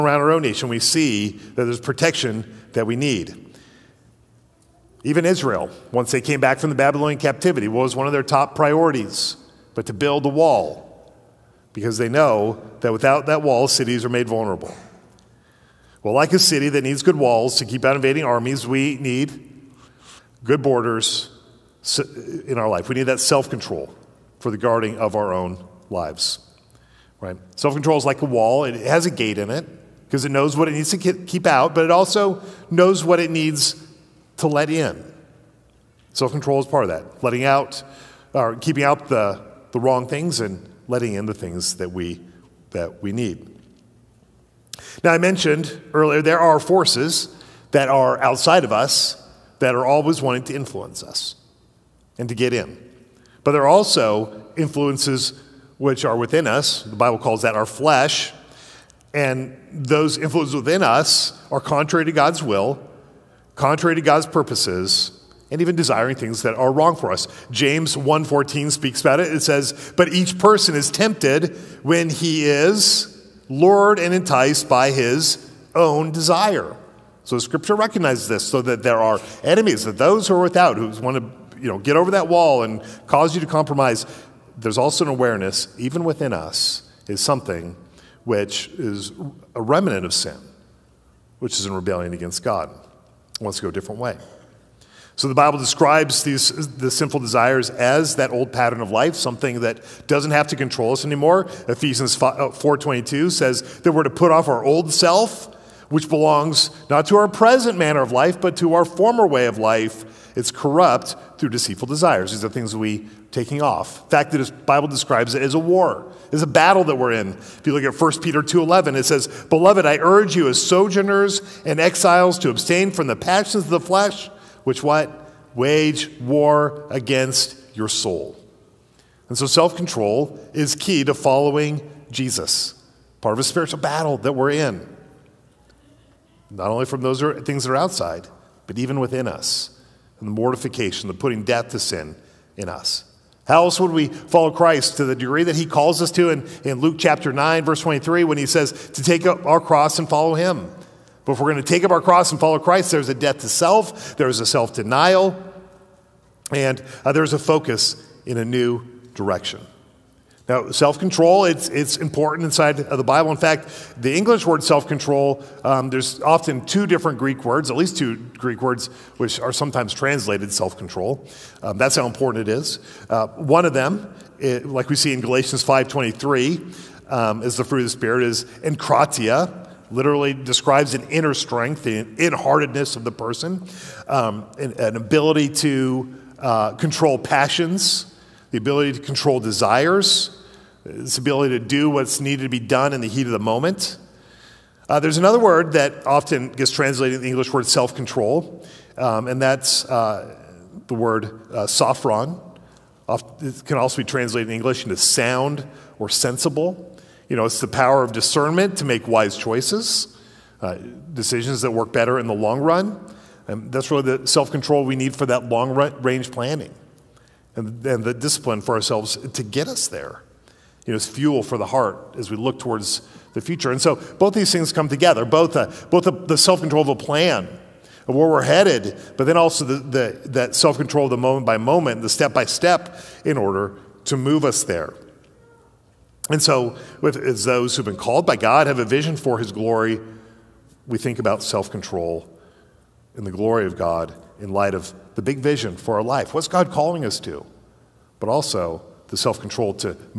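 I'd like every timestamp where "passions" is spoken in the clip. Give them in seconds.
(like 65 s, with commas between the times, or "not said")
123 s, 187 s.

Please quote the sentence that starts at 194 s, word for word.
Uh, there's another word that often gets translated in the English word self control, um, and that's uh, the word uh, sophron.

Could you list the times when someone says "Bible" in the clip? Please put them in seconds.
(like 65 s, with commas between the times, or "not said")
56 s, 95 s, 114 s, 163 s.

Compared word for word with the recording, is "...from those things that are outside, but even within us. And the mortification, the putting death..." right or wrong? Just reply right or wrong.
right.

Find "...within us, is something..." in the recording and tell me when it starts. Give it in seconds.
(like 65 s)
86 s.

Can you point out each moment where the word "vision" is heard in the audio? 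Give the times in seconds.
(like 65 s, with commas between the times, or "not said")
238 s, 245 s.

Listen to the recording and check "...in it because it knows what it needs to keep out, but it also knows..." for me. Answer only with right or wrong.
right.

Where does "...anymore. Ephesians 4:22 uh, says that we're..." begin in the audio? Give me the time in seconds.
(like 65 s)
101 s.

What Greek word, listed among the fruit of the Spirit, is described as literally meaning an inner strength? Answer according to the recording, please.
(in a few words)
enkratia.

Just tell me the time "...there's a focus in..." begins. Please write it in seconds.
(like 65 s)
157 s.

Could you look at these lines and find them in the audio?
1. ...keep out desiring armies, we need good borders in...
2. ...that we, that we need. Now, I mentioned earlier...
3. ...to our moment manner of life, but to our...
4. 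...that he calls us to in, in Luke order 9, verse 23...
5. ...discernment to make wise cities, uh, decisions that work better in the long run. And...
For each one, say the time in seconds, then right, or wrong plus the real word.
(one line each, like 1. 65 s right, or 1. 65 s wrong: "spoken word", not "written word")
1. 17 s wrong: "invading", not "desiring"
2. 41 s right
3. 107 s wrong: "present", not "moment"
4. 145 s wrong: "chapter", not "order"
5. 208 s wrong: "choices", not "cities".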